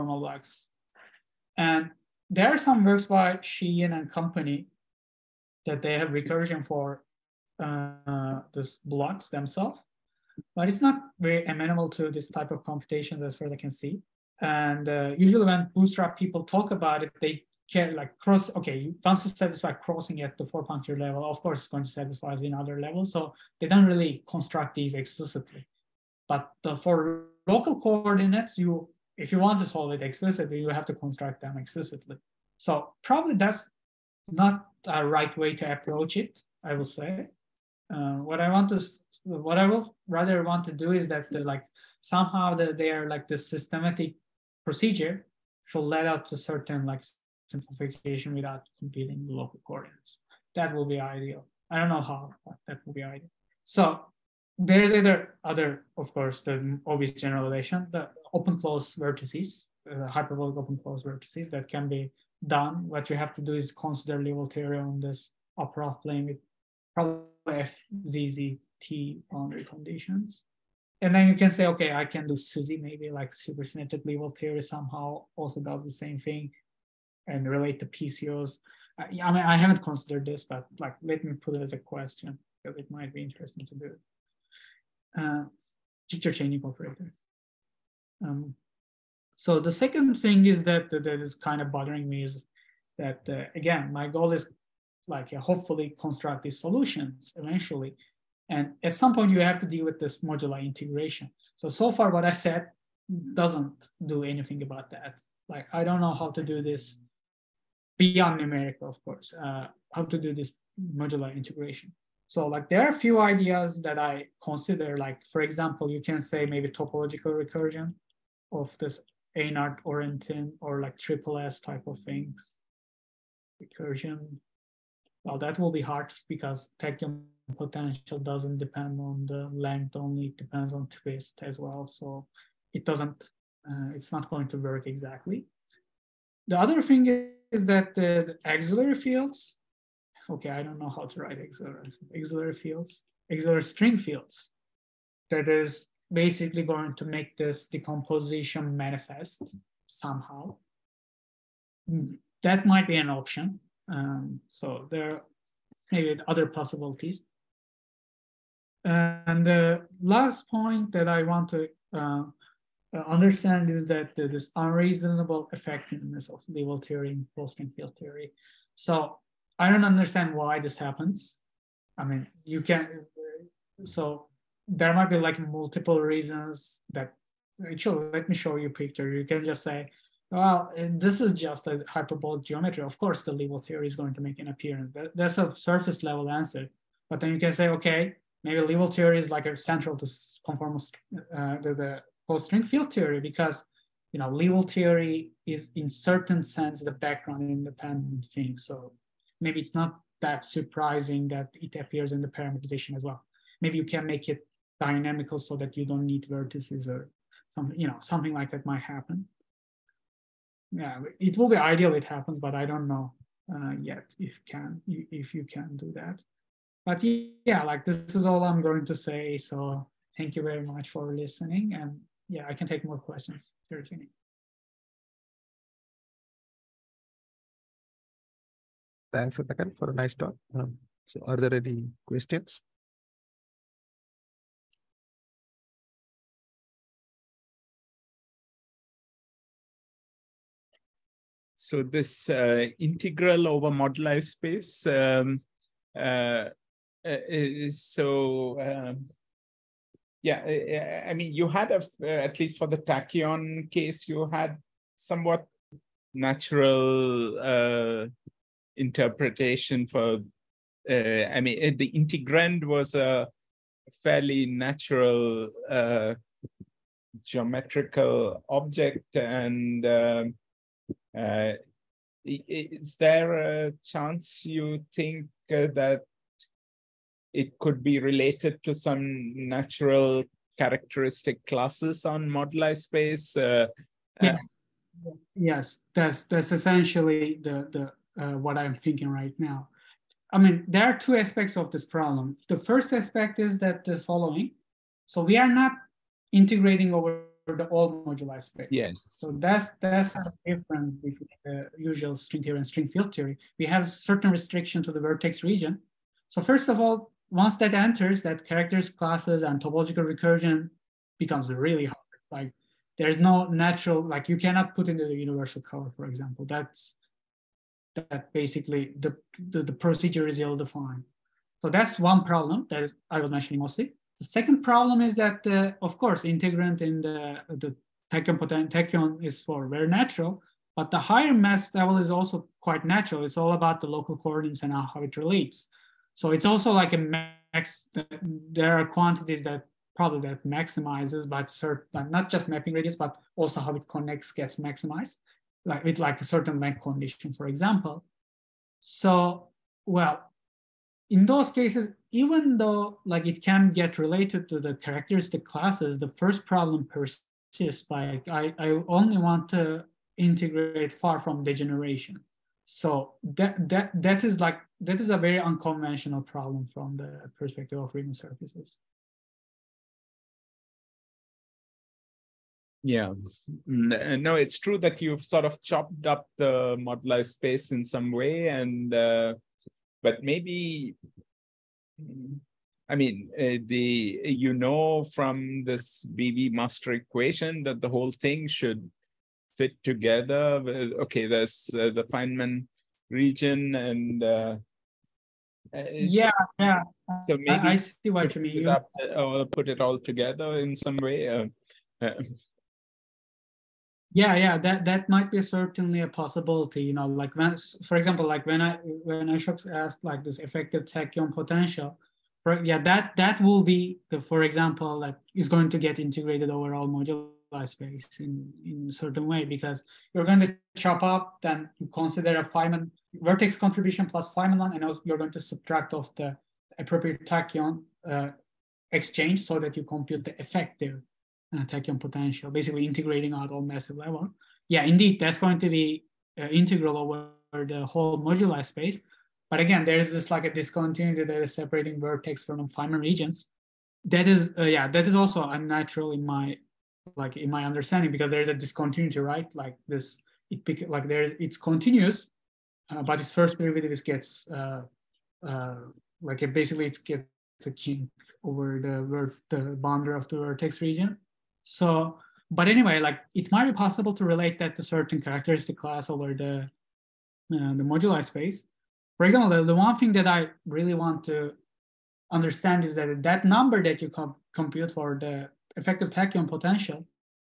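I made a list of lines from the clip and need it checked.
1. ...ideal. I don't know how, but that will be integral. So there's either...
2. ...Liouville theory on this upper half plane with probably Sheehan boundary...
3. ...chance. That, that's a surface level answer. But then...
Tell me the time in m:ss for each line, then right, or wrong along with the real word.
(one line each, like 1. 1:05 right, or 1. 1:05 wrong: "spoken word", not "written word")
1. 0:50 wrong: "ideal", not "integral"
2. 1:04 wrong: "FZZT", not "Sheehan"
3. 3:04 wrong: "appearance", not "chance".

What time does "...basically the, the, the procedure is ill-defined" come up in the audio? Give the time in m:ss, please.
5:18.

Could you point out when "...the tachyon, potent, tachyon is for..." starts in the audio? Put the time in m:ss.
5:27.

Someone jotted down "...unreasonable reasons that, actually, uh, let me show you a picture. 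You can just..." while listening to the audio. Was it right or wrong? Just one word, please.
wrong.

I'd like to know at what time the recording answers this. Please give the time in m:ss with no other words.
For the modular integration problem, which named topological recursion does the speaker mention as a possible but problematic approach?
1:59.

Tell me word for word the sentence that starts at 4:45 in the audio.
Uh, yes, that's that's essentially the the uh, what I'm thinking right now.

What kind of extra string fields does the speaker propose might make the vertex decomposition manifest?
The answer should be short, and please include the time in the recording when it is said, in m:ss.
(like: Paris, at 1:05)
Auxiliary string fields, at 2:23.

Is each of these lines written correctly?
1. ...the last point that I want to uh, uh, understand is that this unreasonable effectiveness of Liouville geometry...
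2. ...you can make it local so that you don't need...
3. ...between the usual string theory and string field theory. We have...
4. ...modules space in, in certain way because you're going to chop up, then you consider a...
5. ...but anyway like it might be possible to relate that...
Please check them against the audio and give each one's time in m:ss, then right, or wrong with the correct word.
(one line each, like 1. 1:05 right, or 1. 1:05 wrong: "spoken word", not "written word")
1. 2:39 wrong: "theory", not "geometry"
2. 3:23 wrong: "dynamical", not "local"
3. 5:01 right
4. 6:56 right
5. 7:42 right.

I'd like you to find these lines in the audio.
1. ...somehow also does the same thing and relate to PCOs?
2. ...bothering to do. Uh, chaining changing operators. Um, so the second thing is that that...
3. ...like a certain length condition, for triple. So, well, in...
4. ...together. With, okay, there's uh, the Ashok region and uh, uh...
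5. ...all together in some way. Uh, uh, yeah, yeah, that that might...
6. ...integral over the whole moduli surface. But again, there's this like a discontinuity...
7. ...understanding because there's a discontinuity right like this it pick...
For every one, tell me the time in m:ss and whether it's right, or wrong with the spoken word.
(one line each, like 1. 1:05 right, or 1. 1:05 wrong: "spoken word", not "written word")
1. 1:14 right
2. 1:23 wrong: "interesting", not "bothering"
3. 5:45 wrong: "example", not "triple"
4. 6:29 wrong: "Feynman", not "Ashok"
5. 6:39 right
6. 7:16 wrong: "space", not "surface"
7. 7:27 right.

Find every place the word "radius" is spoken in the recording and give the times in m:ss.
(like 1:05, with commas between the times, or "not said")
5:42.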